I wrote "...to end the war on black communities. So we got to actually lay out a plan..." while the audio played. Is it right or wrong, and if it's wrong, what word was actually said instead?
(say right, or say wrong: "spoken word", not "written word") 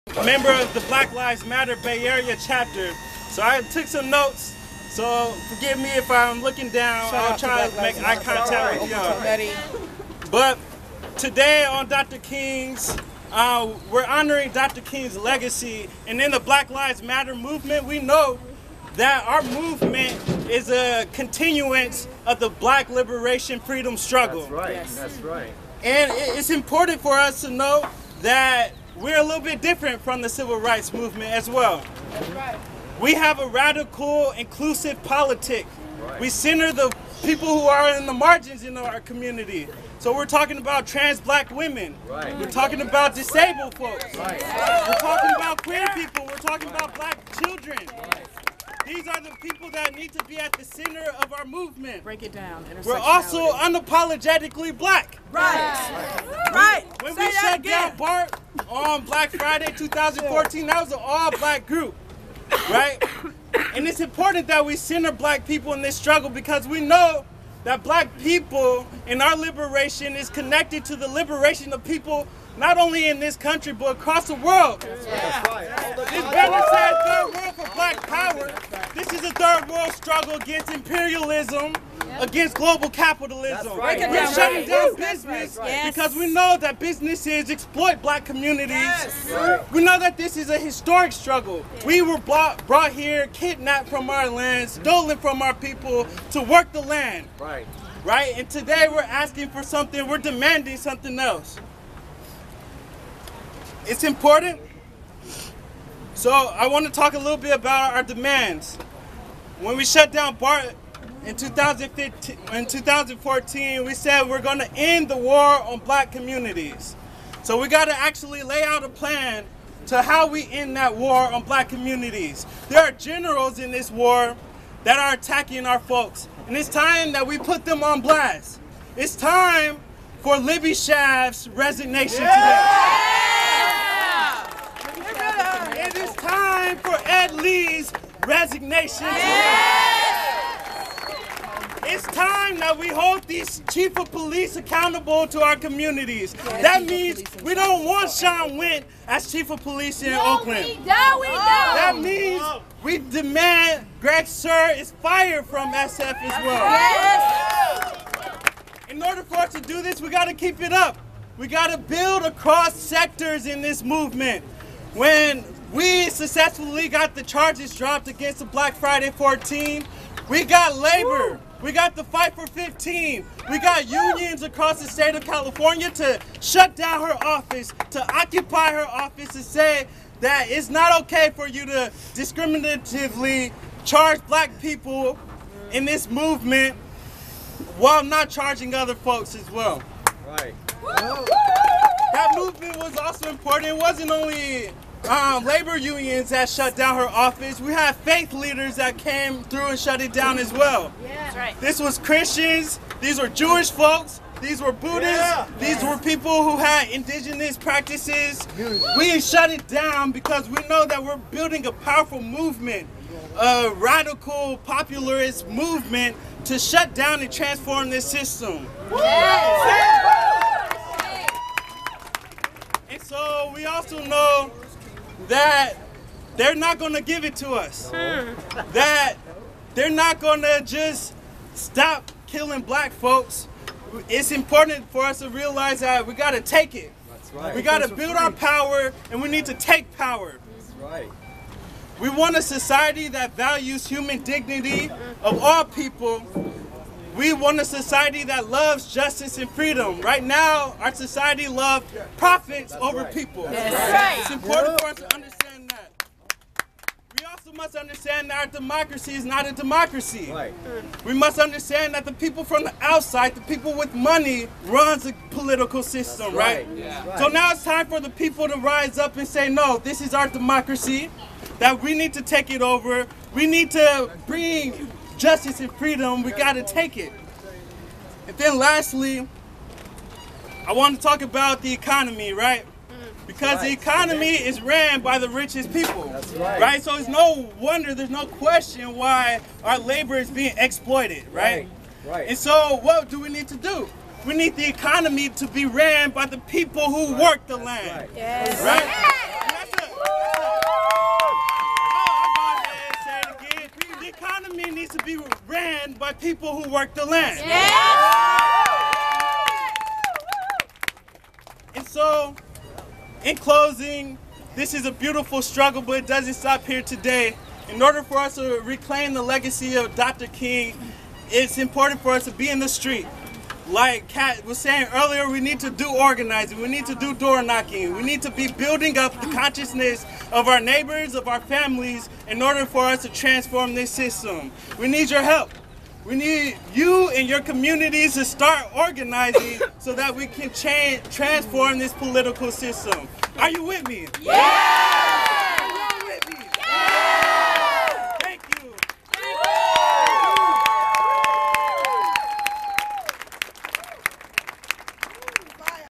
right.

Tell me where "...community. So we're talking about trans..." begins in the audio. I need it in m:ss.
0:39.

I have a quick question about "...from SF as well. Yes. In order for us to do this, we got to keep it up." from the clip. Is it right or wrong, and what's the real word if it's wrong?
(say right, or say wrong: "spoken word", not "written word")
right.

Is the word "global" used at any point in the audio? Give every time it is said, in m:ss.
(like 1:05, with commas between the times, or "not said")
1:22.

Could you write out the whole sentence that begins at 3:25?
were people who had indigenous practices.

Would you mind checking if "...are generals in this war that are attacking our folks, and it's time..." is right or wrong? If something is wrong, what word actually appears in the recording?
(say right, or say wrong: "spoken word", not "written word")
right.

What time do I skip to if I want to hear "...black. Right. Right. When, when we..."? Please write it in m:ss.
0:54.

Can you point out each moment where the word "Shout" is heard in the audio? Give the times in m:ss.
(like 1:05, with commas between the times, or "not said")
0:07.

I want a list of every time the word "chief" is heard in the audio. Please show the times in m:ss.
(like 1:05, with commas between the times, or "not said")
2:23, 2:29.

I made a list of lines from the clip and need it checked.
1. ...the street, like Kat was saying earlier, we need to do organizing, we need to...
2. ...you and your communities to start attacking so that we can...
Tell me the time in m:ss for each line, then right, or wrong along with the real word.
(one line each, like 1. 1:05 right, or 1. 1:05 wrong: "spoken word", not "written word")
1. 5:22 right
2. 5:36 wrong: "organizing", not "attacking".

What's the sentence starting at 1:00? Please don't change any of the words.
That was an all black group, right?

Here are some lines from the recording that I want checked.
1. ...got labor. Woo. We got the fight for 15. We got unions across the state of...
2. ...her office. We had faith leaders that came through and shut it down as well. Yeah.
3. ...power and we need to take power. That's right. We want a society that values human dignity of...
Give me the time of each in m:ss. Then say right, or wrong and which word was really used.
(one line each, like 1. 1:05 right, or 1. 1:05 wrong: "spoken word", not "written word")
1. 2:50 right
2. 3:16 right
3. 3:58 right.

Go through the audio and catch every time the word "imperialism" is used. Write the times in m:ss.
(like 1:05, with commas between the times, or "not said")
1:20.